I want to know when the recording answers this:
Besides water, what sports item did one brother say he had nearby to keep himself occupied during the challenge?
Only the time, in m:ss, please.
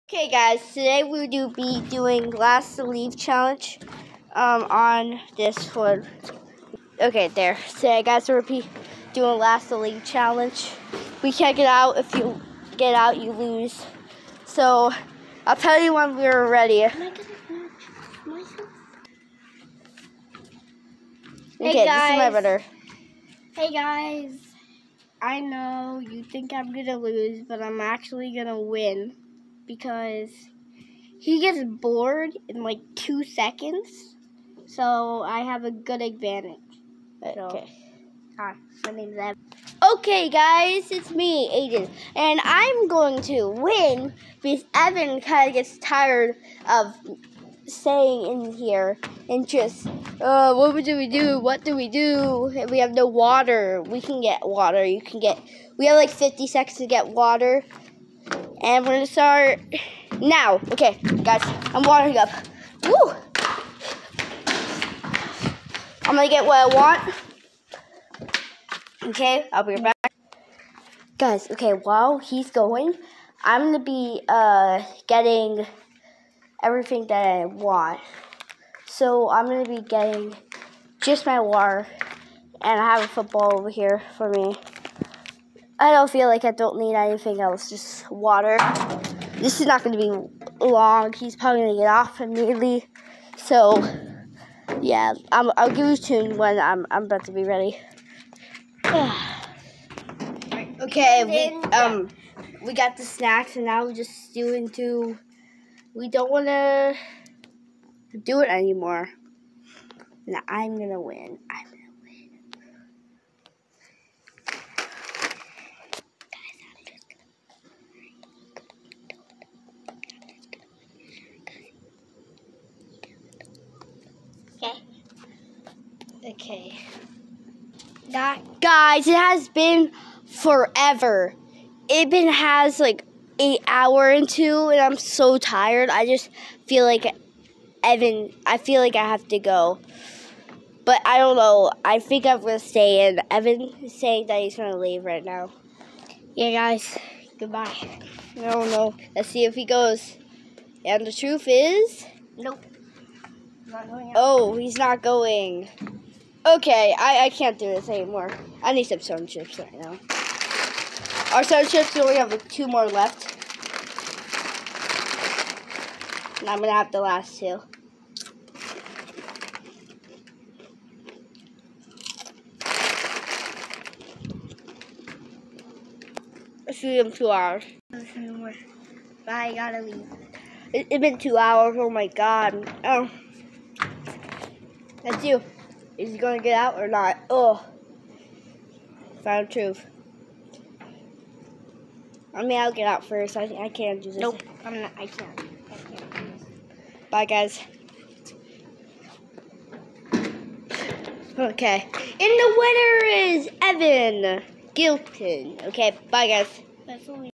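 1:23.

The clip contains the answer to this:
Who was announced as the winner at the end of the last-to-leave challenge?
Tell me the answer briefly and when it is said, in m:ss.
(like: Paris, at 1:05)
Evan Gilton, at 3:23.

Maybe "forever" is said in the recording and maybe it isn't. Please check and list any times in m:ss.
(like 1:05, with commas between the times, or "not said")
2:10.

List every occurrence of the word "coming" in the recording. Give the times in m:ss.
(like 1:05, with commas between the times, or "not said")
not said.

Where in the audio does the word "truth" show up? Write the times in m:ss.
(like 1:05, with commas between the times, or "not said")
2:31, 3:09.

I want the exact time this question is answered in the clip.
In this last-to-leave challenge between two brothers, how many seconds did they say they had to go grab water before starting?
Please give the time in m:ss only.
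0:56.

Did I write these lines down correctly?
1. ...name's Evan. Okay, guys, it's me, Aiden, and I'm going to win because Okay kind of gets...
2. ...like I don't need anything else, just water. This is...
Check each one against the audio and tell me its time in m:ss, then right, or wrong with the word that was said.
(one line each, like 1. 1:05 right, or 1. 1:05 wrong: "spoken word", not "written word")
1. 0:38 wrong: "Evan", not "Okay"
2. 1:26 right.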